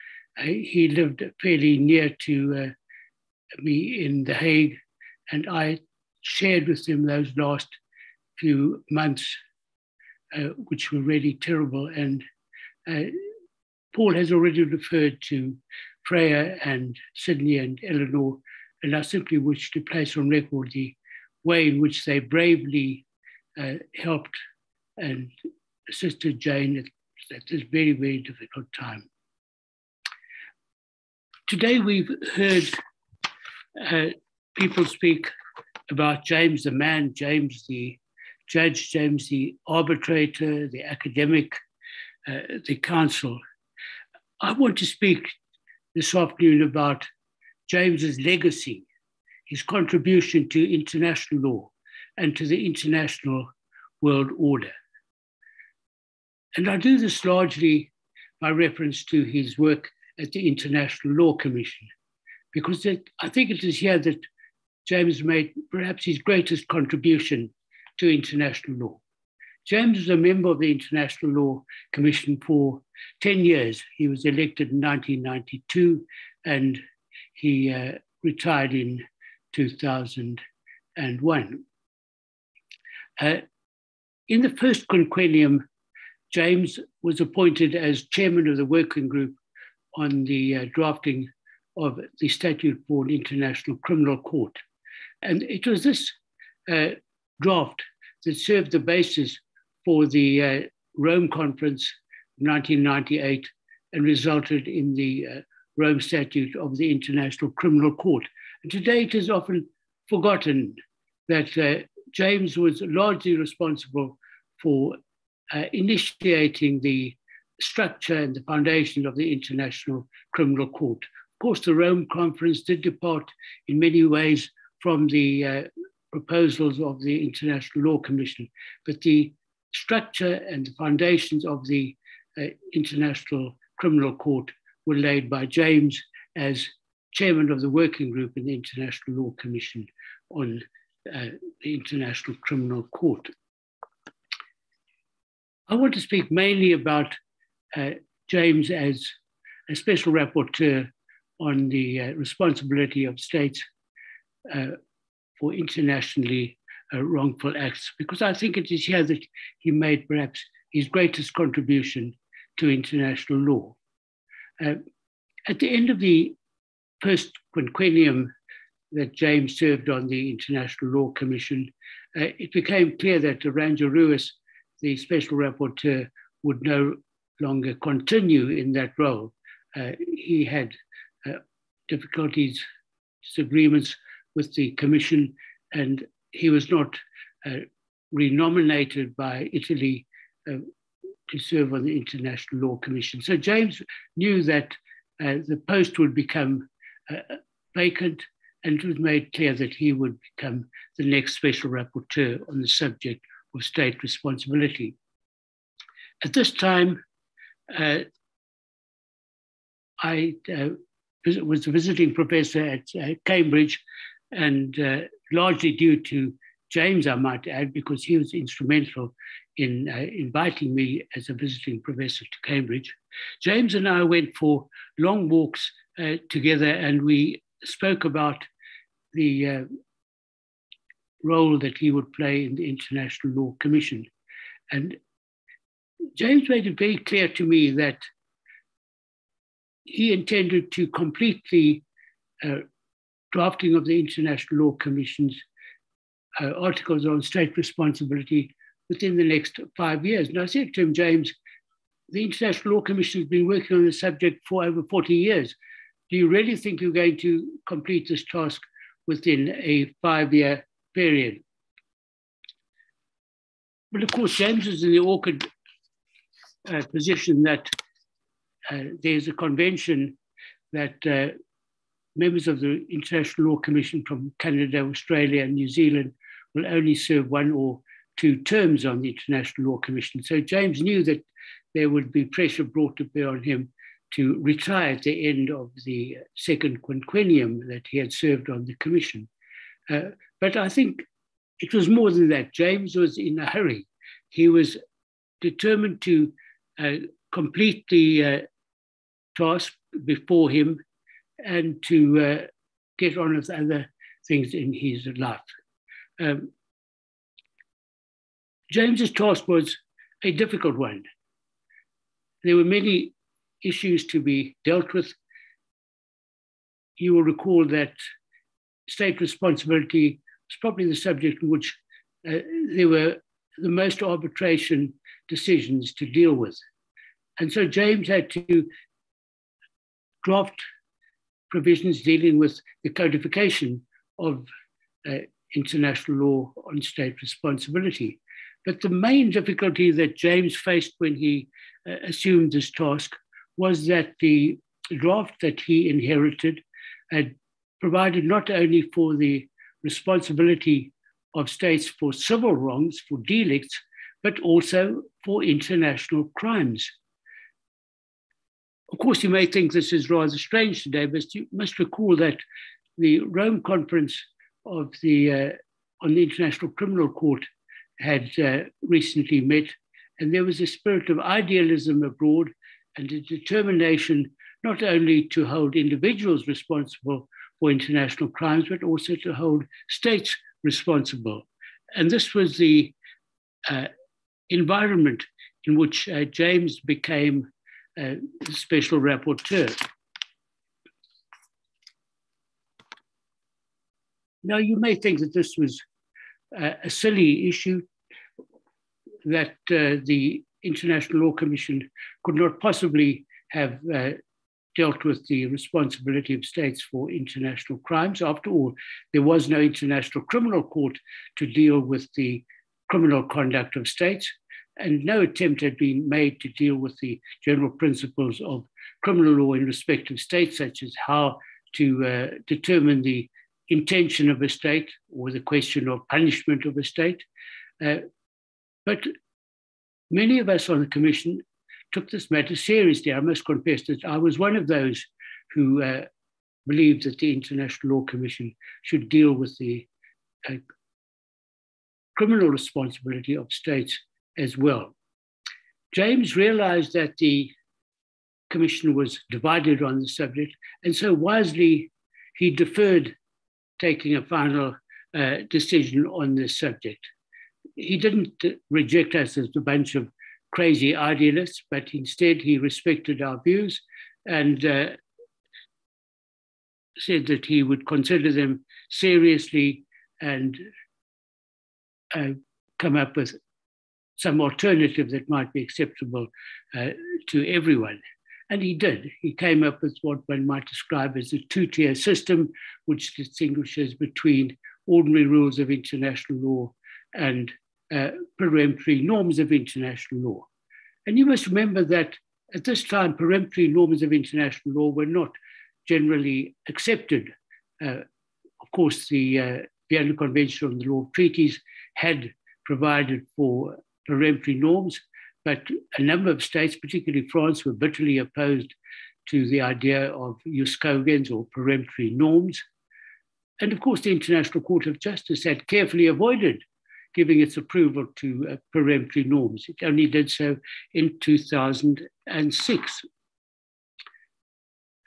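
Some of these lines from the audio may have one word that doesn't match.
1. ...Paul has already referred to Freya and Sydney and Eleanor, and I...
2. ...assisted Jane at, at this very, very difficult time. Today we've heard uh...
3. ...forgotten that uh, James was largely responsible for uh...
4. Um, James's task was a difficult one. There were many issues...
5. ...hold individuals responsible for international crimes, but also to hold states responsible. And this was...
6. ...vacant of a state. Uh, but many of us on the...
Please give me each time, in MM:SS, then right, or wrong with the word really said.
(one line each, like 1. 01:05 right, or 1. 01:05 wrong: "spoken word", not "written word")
1. 00:13 right
2. 00:25 right
3. 01:50 right
4. 05:06 right
5. 06:15 right
6. 07:06 wrong: "punishment", not "vacant".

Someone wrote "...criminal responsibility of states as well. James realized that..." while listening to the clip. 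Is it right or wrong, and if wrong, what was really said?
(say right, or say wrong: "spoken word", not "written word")
right.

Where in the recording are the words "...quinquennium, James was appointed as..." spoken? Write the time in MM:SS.
01:24.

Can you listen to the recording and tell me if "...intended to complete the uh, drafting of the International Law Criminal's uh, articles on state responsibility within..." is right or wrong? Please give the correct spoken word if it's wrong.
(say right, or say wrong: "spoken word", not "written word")
wrong: "Commission", not "Criminal".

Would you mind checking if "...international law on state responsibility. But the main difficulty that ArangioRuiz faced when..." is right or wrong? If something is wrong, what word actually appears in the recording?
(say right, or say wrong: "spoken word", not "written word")
wrong: "James", not "ArangioRuiz".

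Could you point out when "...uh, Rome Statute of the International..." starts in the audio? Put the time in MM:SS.
01:45.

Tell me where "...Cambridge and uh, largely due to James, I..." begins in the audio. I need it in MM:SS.
03:33.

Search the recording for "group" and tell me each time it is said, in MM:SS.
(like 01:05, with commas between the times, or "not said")
01:29, 02:18.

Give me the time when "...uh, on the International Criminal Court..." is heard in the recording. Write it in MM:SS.
06:05.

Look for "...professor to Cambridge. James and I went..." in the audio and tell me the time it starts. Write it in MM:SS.
03:41.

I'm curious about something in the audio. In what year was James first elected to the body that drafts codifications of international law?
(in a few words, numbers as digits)
1992.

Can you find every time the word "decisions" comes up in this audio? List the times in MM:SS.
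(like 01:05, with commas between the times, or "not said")
05:25, 07:35.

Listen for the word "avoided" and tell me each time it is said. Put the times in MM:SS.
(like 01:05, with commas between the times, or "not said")
08:36.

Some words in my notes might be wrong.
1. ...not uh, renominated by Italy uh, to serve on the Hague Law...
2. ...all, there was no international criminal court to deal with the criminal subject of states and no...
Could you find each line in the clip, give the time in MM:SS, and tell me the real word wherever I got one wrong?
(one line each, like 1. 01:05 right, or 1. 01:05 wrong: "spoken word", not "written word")
1. 03:06 wrong: "International", not "Hague"
2. 06:48 wrong: "conduct", not "subject".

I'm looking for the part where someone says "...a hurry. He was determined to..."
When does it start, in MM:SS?
04:53.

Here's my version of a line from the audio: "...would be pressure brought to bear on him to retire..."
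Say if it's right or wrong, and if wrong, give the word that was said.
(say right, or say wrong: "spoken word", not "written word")
right.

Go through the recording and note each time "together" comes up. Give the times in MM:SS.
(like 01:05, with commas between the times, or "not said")
03:46.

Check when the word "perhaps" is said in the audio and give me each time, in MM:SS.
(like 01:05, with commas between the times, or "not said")
01:05, 02:40.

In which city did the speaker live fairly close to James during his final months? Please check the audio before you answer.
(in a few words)
The Hague.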